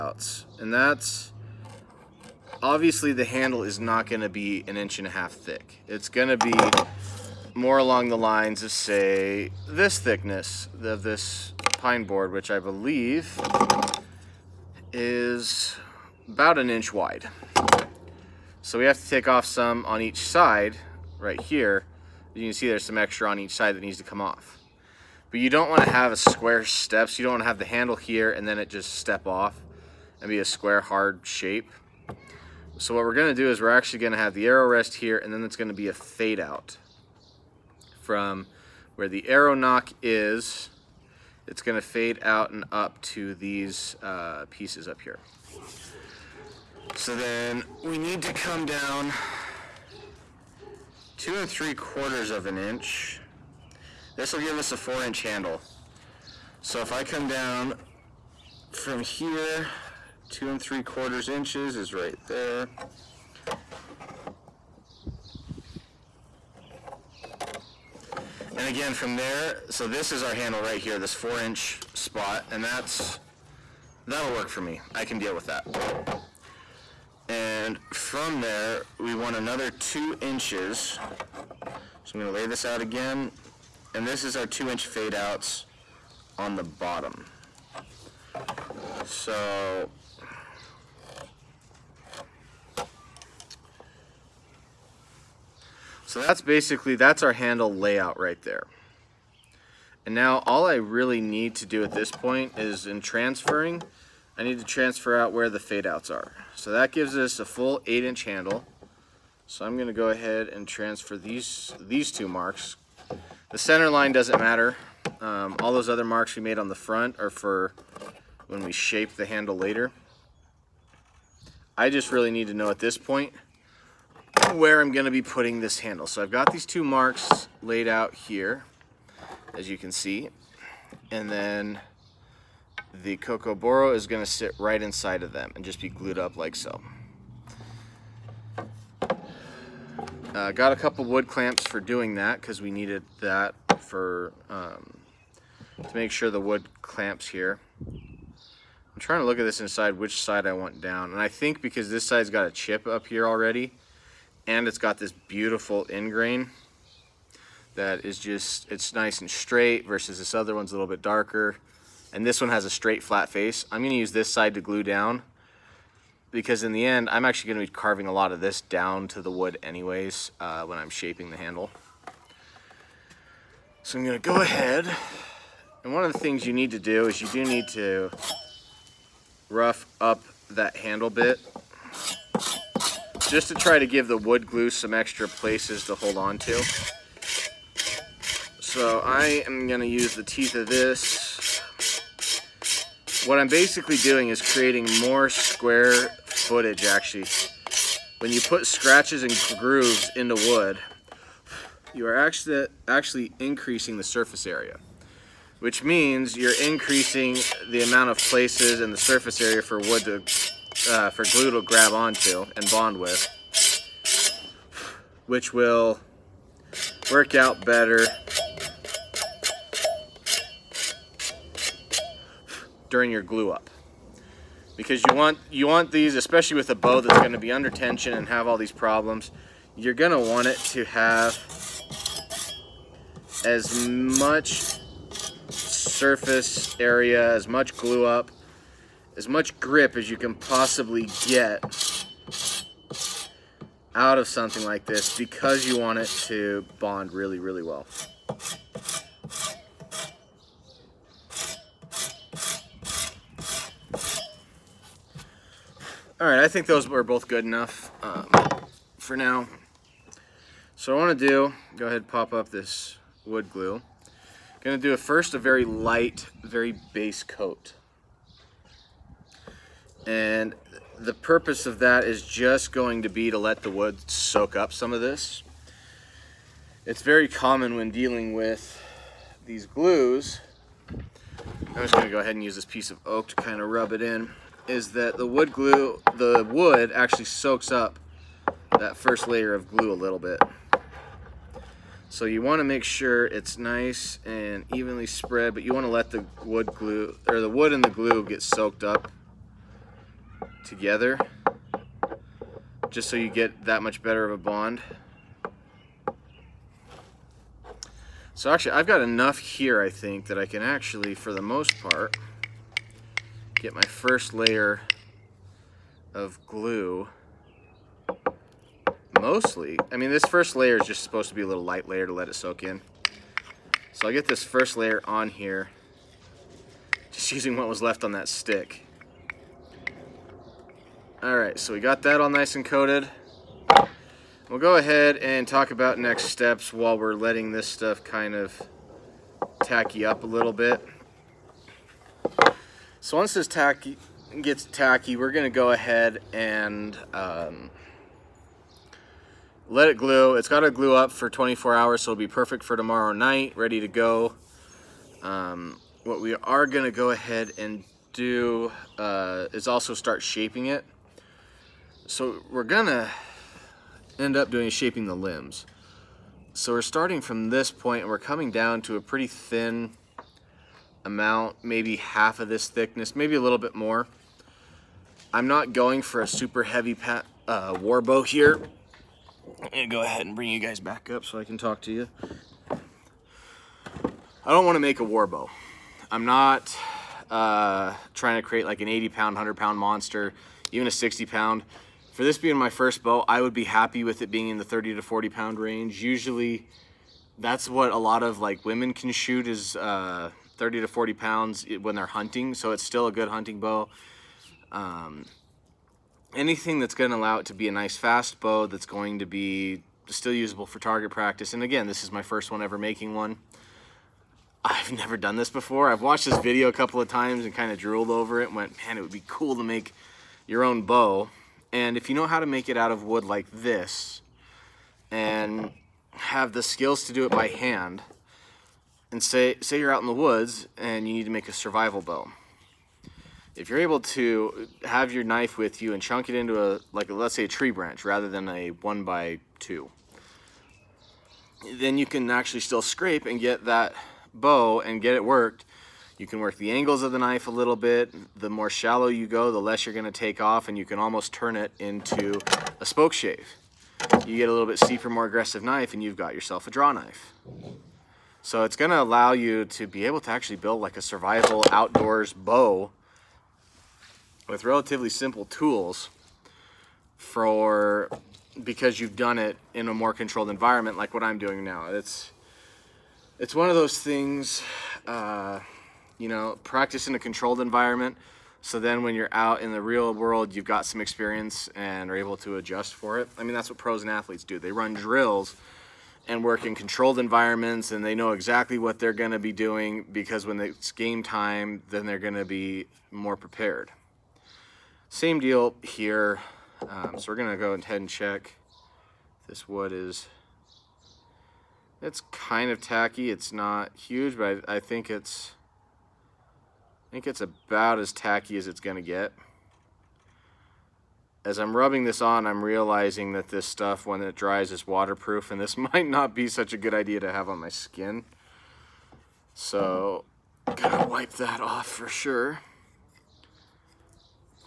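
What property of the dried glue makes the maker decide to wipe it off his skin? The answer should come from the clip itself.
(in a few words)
waterproof.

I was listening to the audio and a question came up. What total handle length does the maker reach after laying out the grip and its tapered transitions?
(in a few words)
8 inches.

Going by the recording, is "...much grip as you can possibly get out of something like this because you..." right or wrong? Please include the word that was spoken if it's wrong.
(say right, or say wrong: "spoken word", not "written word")
right.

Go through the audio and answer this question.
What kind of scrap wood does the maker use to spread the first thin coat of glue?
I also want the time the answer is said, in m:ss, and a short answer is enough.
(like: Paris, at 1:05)
oak, at 4:43.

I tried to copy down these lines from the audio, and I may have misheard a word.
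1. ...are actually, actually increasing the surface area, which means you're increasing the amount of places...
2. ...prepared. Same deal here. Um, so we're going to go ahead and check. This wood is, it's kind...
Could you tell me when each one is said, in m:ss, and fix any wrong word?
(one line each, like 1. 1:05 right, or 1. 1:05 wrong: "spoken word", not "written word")
1. 3:22 right
2. 8:13 right.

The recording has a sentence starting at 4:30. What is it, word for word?
And the purpose of that is just going to be to let the wood soak up some of this.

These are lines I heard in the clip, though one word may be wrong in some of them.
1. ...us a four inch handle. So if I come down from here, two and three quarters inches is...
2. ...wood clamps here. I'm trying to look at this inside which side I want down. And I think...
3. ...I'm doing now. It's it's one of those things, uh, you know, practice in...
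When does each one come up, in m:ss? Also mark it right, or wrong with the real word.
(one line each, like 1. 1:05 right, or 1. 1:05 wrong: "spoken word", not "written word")
1. 0:54 right
2. 2:26 right
3. 7:51 right.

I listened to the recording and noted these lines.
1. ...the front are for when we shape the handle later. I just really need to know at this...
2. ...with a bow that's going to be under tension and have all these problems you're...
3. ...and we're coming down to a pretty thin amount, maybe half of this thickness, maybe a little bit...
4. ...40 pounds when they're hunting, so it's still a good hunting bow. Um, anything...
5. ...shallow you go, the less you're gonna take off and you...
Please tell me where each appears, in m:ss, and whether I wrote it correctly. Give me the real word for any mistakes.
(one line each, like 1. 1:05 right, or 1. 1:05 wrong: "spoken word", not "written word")
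1. 1:56 right
2. 3:46 right
3. 6:08 right
4. 6:40 right
5. 7:28 right.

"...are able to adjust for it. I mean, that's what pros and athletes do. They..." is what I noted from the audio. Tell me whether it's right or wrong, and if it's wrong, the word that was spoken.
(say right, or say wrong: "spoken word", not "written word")
right.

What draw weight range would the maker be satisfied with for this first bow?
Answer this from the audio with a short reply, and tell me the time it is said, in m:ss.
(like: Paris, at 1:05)
30 to 40 pounds, at 6:34.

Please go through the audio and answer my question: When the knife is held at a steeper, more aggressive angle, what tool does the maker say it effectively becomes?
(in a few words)
draw knife.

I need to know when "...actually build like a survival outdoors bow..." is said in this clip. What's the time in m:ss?
7:40.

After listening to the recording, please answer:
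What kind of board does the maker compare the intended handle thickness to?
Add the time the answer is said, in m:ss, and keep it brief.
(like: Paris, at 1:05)
pine board, at 0:11.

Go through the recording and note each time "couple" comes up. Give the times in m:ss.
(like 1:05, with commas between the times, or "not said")
2:20, 6:56.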